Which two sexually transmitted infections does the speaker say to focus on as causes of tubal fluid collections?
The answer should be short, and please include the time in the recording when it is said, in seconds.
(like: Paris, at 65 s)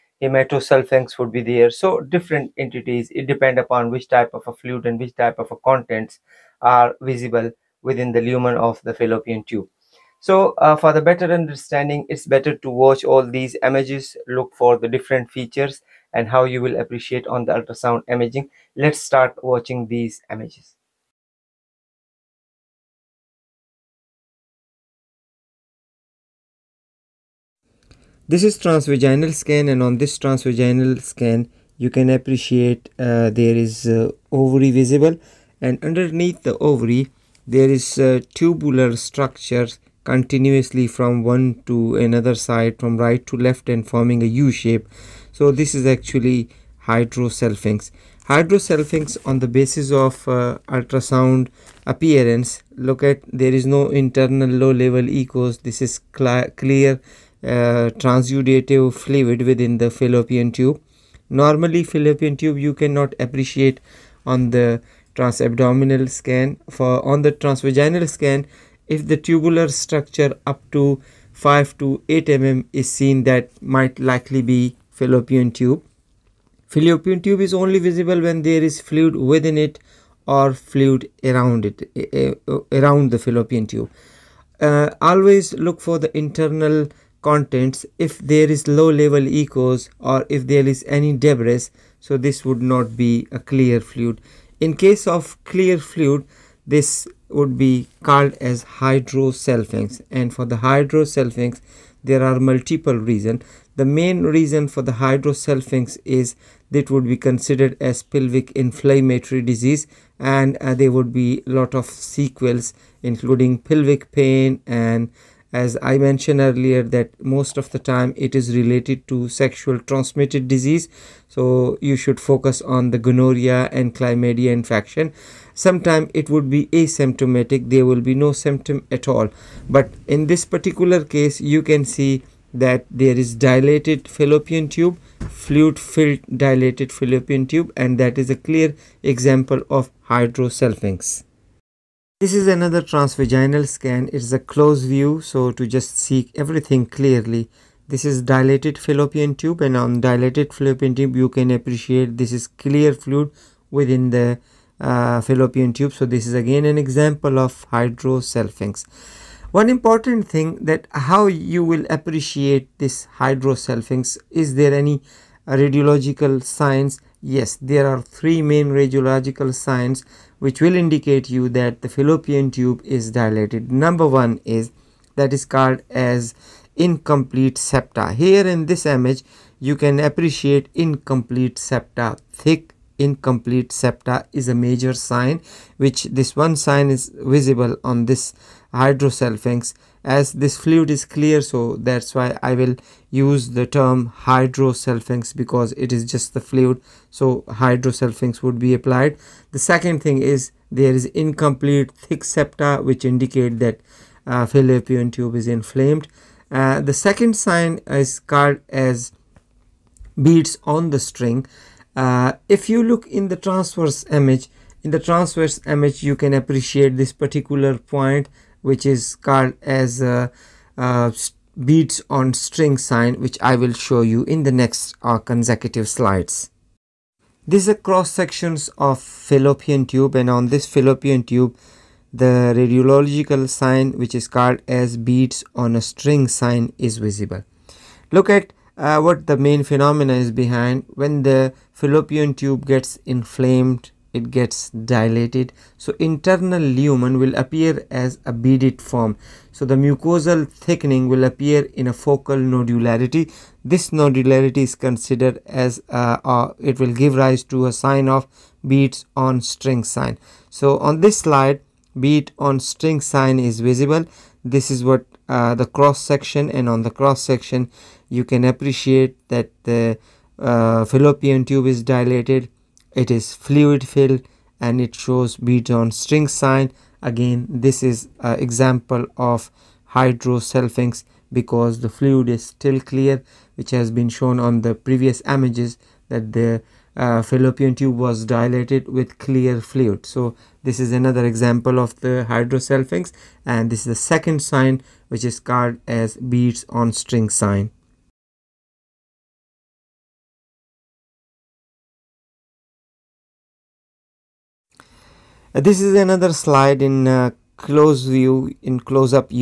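gonorrhea and chlamydia, at 123 s.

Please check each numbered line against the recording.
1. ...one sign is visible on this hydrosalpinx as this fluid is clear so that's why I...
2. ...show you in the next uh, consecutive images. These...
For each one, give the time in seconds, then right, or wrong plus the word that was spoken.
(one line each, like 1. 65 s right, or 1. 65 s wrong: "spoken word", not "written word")
1. 186 s right
2. 223 s wrong: "slides", not "images".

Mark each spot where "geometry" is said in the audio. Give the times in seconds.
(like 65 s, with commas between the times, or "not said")
not said.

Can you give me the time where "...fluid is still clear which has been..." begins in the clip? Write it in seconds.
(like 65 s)
281 s.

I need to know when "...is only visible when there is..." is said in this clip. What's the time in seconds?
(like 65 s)
77 s.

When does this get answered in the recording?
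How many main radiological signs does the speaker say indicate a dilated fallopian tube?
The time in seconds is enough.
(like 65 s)
168 s.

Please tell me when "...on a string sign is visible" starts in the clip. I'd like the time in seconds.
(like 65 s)
235 s.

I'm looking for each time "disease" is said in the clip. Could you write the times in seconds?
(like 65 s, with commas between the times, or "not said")
109 s, 120 s.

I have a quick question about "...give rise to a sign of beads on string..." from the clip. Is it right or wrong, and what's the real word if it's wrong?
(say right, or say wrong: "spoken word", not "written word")
right.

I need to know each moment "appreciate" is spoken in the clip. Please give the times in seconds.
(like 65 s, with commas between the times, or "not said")
16 s, 32 s, 63 s, 151 s, 161 s, 179 s, 216 s, 268 s.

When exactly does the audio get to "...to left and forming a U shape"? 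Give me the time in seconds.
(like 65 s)
43 s.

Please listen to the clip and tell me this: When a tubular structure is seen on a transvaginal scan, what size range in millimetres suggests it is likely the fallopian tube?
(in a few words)
5 to 8 mm.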